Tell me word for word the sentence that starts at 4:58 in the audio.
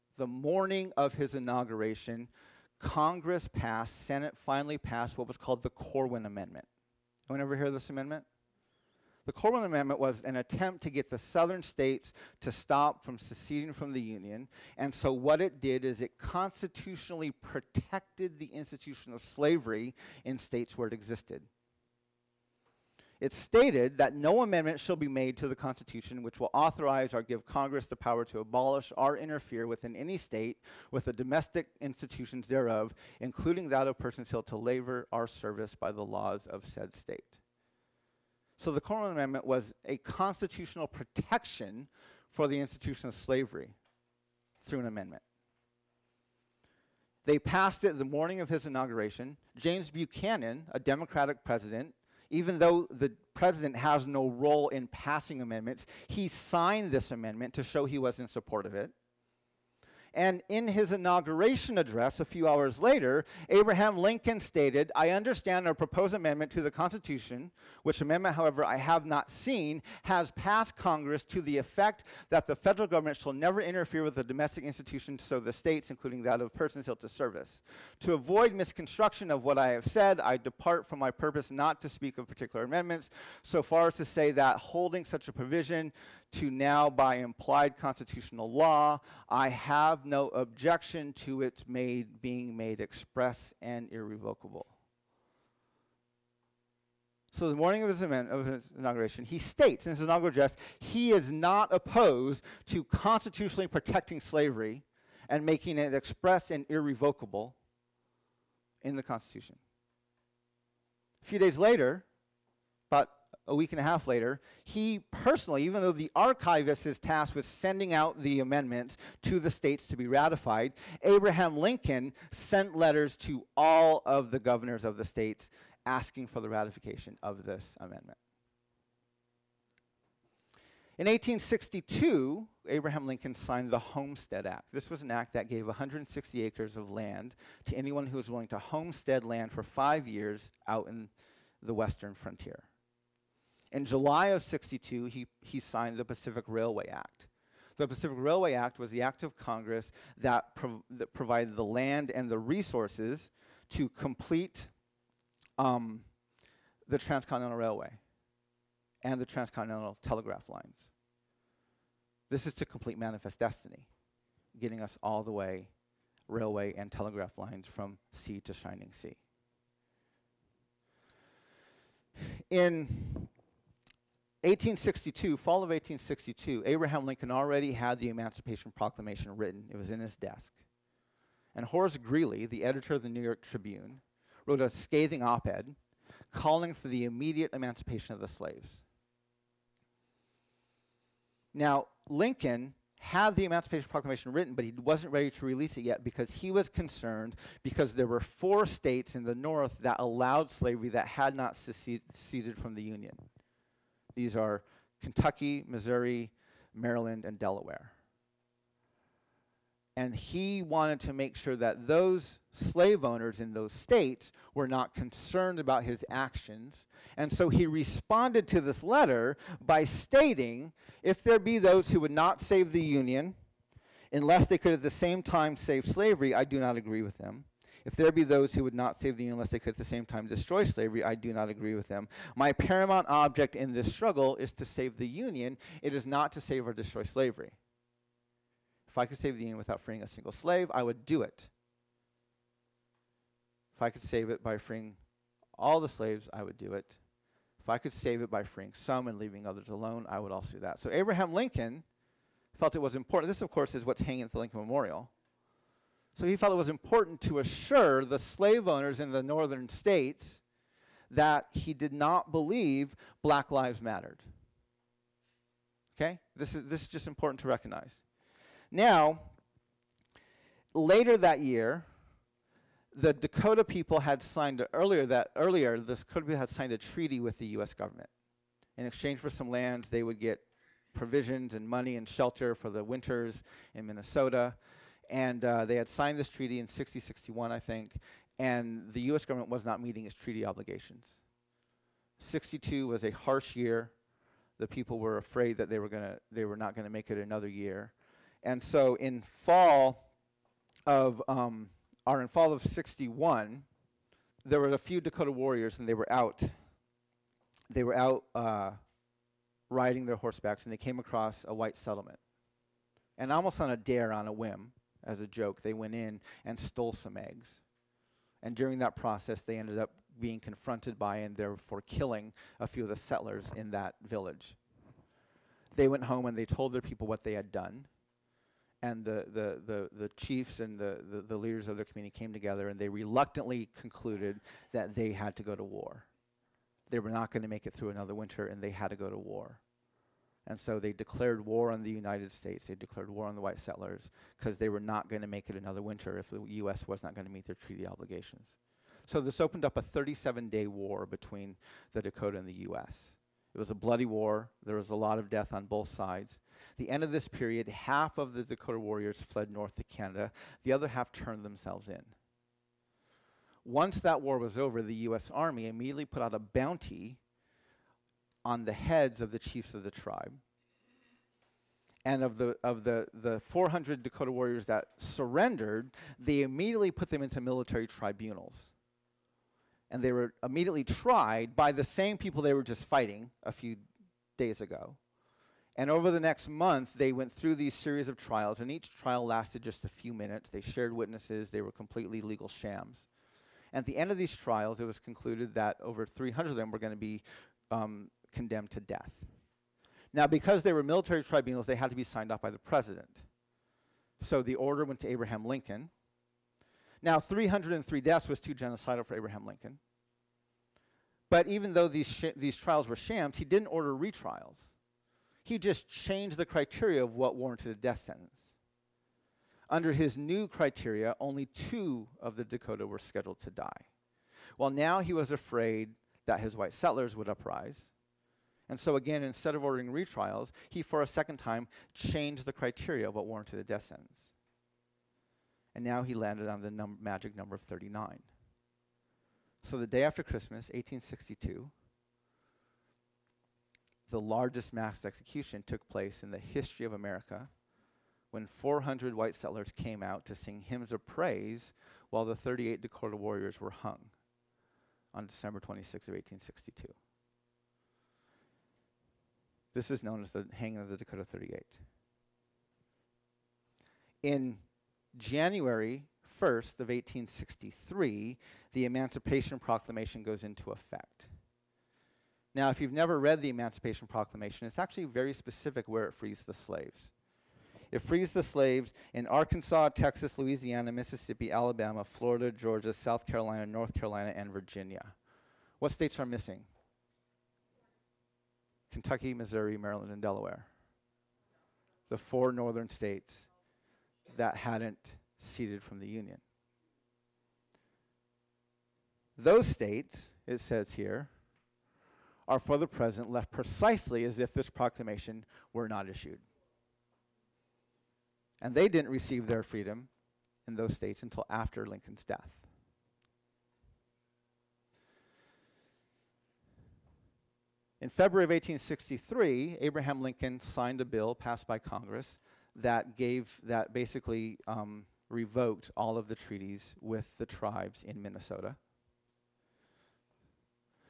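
And so in fall of, um, or in fall of 61, there were a few Dakota warriors and they were out.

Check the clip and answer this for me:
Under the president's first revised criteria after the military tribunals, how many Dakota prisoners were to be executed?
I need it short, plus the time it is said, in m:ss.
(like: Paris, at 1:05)
2, at 7:01.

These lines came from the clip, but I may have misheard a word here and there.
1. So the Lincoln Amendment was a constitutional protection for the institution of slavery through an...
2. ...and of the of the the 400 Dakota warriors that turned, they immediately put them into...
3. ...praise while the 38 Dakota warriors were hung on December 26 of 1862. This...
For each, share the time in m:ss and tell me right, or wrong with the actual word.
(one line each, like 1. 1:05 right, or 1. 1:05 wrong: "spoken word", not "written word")
1. 0:38 wrong: "Corwin", not "Lincoln"
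2. 6:12 wrong: "surrendered", not "turned"
3. 7:31 right.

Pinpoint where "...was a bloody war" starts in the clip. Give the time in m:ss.
5:53.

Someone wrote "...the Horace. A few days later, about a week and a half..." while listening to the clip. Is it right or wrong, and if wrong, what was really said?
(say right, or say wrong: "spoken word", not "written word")
wrong: "Constitution", not "Horace".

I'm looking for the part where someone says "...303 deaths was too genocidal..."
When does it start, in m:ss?
6:47.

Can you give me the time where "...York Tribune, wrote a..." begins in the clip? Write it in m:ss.
3:03.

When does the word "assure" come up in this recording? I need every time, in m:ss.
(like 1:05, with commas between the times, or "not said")
4:17.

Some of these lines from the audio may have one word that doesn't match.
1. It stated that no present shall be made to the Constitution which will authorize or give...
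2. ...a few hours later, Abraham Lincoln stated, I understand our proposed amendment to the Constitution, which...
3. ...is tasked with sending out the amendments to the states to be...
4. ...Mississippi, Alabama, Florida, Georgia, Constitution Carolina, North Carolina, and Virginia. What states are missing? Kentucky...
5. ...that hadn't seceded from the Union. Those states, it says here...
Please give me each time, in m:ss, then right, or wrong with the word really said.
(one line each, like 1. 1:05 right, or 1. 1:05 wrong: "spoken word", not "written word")
1. 0:23 wrong: "amendment", not "present"
2. 1:02 right
3. 1:56 right
4. 8:00 wrong: "South", not "Constitution"
5. 8:14 right.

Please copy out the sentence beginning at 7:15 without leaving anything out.
And now he landed on the num magic number of 39.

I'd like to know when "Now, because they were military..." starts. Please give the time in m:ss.
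6:40.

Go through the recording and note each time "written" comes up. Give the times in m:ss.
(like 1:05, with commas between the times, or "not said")
2:59, 3:14.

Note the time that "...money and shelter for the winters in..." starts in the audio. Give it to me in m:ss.
4:41.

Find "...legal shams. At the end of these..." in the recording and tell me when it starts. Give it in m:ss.
6:32.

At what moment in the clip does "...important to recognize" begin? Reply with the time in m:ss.
4:27.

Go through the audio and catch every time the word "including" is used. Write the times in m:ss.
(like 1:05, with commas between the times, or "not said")
0:33, 1:15.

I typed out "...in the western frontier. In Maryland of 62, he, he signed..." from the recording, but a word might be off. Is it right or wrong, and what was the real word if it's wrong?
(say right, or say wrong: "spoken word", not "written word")
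wrong: "July", not "Maryland".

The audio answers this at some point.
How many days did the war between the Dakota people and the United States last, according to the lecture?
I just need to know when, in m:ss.
5:49.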